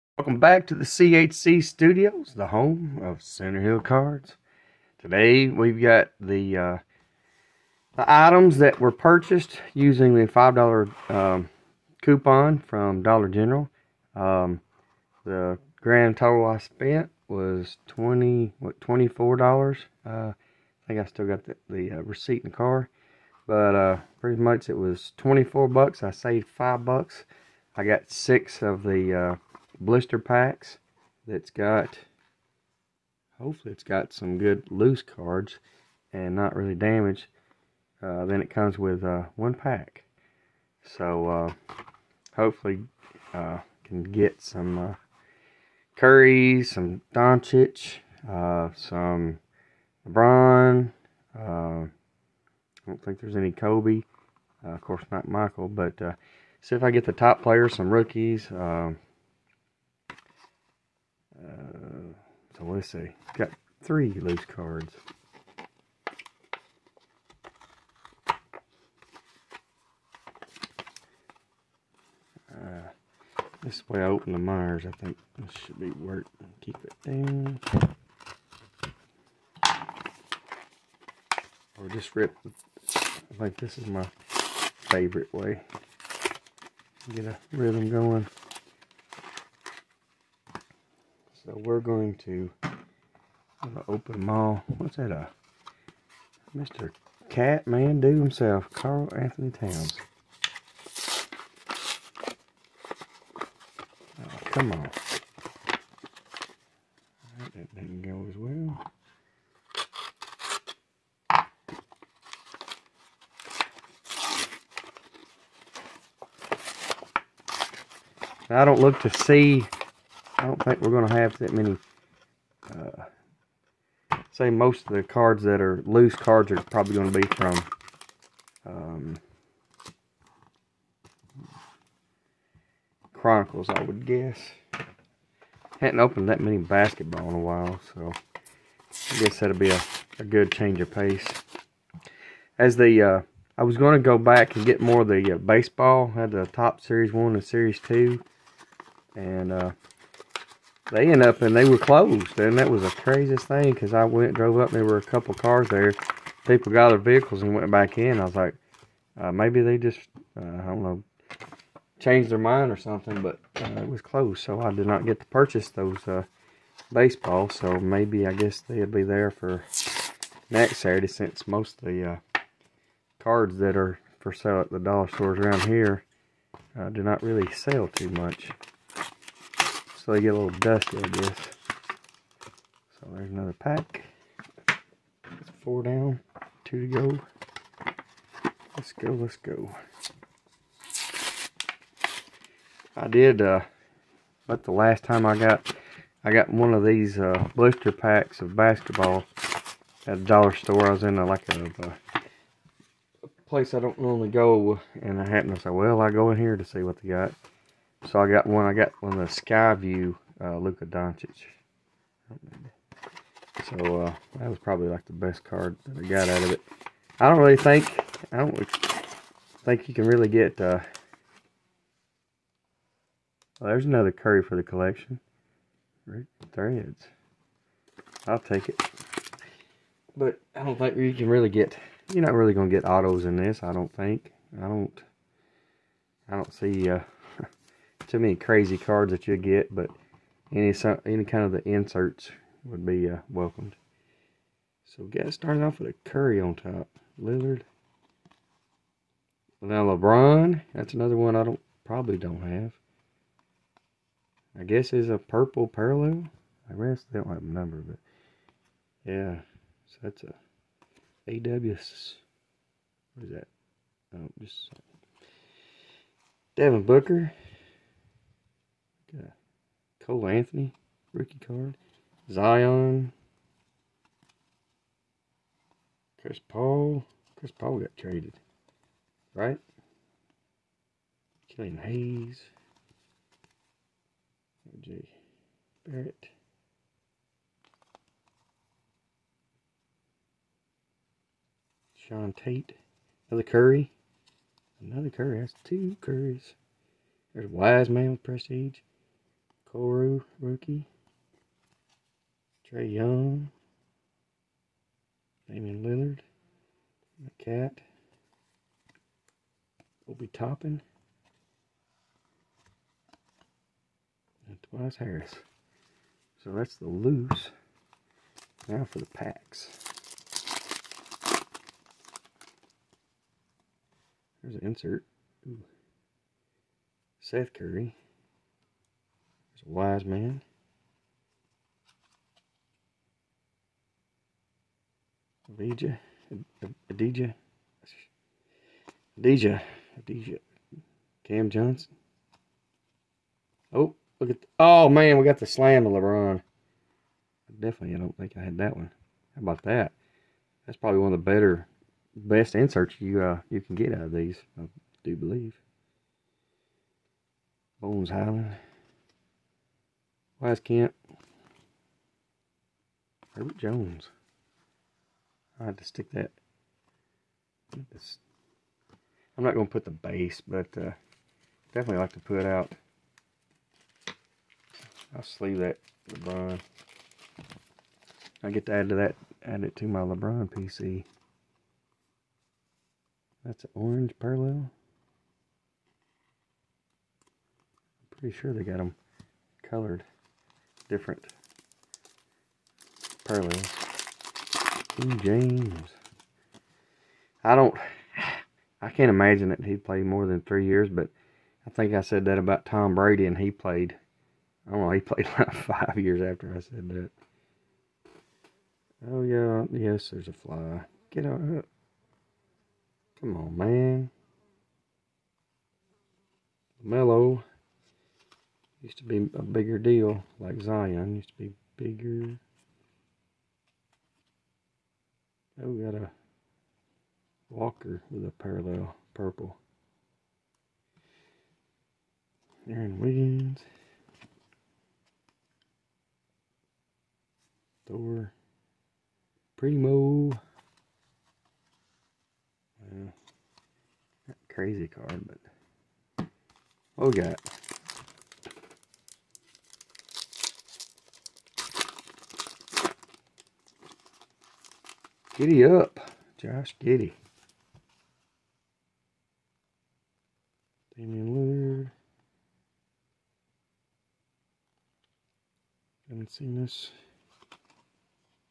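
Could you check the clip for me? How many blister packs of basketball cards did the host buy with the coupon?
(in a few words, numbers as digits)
6.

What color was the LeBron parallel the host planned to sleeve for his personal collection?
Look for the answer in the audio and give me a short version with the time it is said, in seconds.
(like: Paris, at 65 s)
Orange, at 383 s.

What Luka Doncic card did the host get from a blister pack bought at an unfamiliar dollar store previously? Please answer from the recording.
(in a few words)
Skyview.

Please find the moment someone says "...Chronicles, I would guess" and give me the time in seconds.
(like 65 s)
133 s.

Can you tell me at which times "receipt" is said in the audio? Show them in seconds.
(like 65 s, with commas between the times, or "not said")
22 s.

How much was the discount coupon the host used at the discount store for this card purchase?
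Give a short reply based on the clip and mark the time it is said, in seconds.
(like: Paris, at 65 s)
$5, at 10 s.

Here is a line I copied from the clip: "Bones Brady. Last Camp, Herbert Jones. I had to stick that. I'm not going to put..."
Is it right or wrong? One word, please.
wrong.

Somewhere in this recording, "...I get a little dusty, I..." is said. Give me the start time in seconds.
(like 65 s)
180 s.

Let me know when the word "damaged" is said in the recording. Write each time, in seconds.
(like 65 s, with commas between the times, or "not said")
36 s.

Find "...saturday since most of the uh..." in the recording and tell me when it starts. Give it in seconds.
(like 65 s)
170 s.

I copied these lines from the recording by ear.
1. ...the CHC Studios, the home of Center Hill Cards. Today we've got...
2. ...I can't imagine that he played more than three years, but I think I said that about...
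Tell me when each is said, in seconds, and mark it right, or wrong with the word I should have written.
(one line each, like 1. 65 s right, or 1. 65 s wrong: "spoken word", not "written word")
1. 0 s right
2. 398 s right.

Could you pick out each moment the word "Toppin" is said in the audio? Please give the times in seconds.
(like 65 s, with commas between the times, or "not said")
310 s.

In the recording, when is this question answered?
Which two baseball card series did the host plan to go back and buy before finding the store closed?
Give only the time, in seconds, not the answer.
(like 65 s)
146 s.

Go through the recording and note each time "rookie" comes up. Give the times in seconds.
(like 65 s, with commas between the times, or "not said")
57 s, 271 s, 300 s.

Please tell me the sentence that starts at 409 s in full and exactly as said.
Oh, yeah, yes, there's a fly.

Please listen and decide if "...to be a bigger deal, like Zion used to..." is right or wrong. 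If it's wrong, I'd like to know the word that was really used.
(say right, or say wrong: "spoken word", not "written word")
right.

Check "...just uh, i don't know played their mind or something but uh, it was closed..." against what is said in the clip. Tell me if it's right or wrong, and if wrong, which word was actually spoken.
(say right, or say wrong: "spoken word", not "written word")
wrong: "changed", not "played".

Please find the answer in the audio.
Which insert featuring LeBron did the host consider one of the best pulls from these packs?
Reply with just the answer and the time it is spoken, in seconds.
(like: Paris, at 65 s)
Slam, at 345 s.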